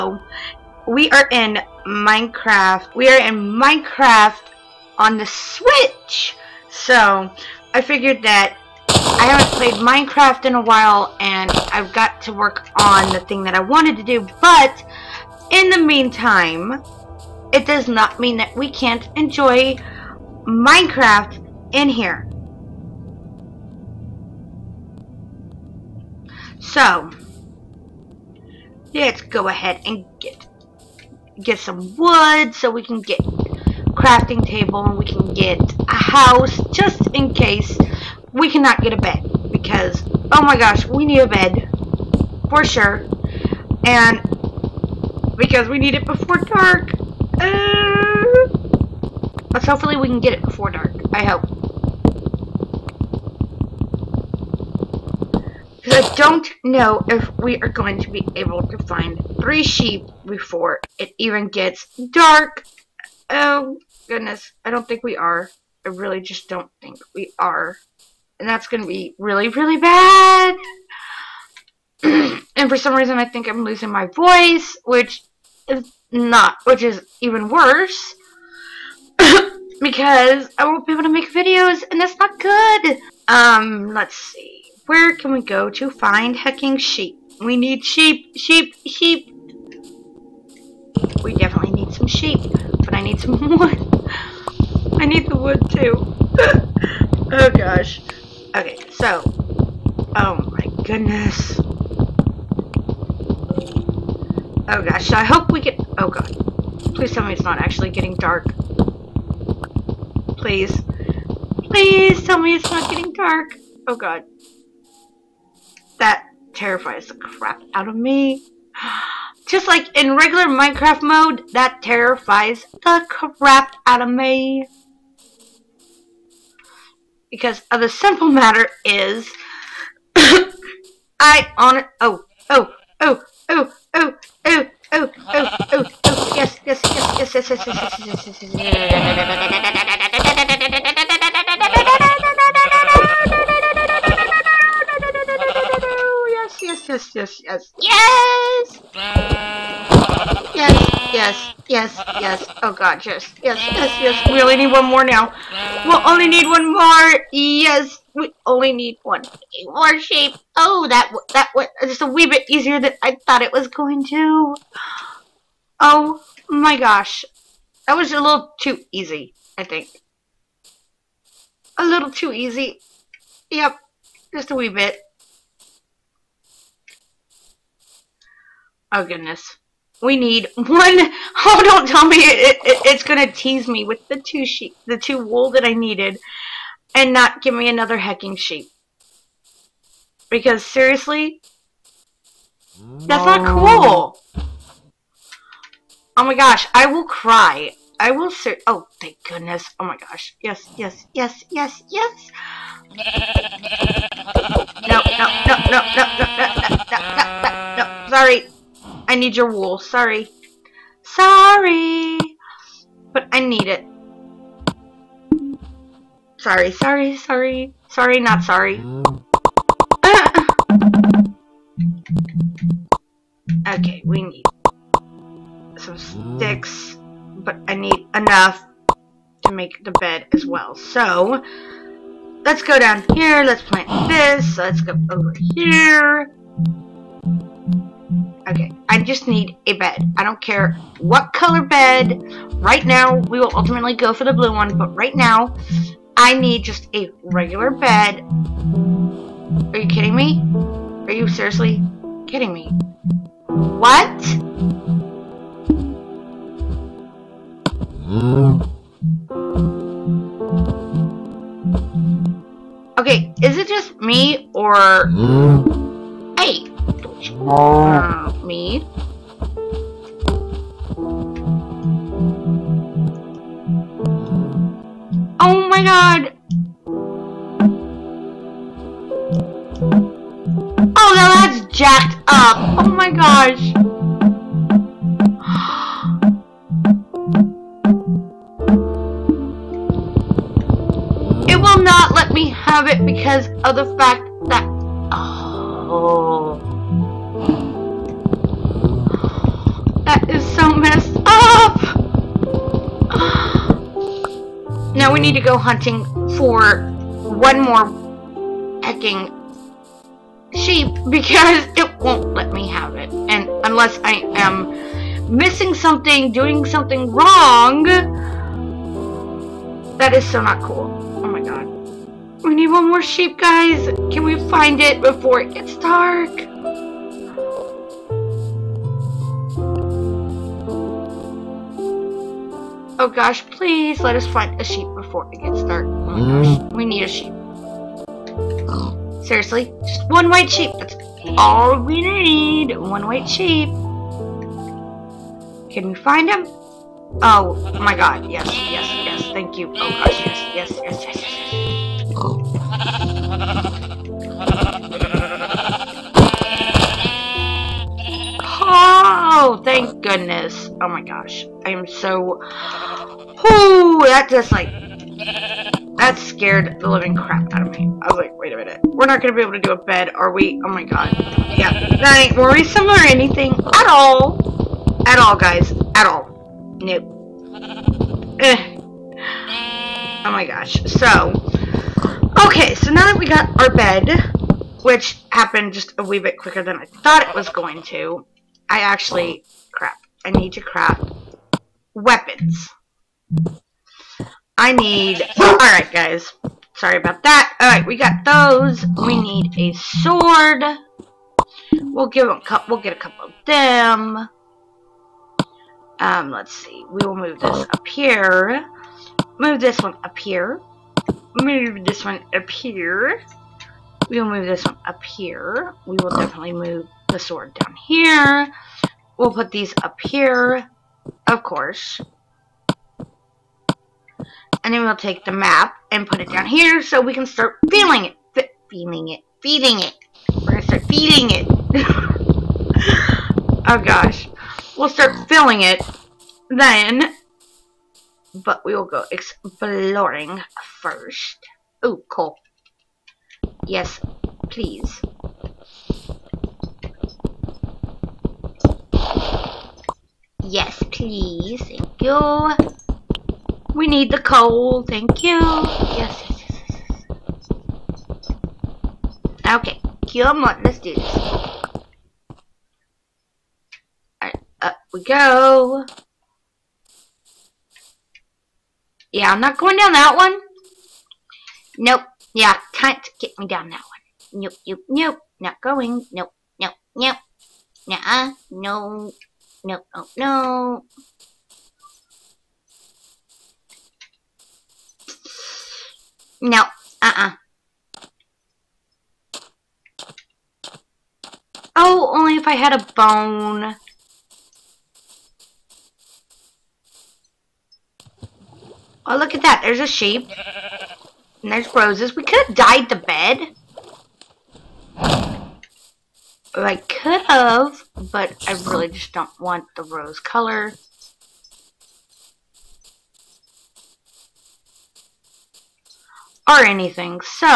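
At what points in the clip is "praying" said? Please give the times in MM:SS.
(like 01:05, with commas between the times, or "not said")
not said.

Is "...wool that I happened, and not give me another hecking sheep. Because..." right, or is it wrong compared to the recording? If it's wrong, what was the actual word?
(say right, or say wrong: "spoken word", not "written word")
wrong: "needed", not "happened".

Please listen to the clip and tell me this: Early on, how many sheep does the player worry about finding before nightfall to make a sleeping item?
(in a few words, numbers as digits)
3.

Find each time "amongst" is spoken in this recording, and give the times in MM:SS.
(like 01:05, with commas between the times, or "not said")
not said.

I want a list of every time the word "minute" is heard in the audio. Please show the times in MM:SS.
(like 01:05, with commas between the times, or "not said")
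06:08.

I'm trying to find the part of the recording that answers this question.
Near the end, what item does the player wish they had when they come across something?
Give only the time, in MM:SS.
08:12.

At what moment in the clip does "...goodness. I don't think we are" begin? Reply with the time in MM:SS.
01:04.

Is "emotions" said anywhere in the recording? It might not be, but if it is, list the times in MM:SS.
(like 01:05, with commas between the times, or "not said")
not said.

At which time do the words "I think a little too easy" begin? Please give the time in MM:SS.
02:49.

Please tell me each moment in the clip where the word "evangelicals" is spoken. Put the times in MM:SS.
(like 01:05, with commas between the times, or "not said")
not said.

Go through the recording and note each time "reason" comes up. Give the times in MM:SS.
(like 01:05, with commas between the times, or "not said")
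01:12.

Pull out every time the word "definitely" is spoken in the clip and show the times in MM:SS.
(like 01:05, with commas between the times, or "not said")
01:31, 06:56.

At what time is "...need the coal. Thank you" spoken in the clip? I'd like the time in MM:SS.
07:33.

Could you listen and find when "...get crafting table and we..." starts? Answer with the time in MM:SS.
00:33.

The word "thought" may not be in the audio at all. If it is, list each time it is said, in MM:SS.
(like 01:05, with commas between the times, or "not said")
02:43, 06:26.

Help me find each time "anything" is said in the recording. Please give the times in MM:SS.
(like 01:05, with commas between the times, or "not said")
06:13, 08:36.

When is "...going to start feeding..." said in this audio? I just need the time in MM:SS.
07:10.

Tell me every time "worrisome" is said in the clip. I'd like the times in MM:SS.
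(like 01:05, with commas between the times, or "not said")
06:12.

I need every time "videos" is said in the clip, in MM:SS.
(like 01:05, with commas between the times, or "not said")
01:21.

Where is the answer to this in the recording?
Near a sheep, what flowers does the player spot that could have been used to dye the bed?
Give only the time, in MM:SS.
08:21.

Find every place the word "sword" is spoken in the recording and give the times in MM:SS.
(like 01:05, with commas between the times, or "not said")
06:39, 06:57.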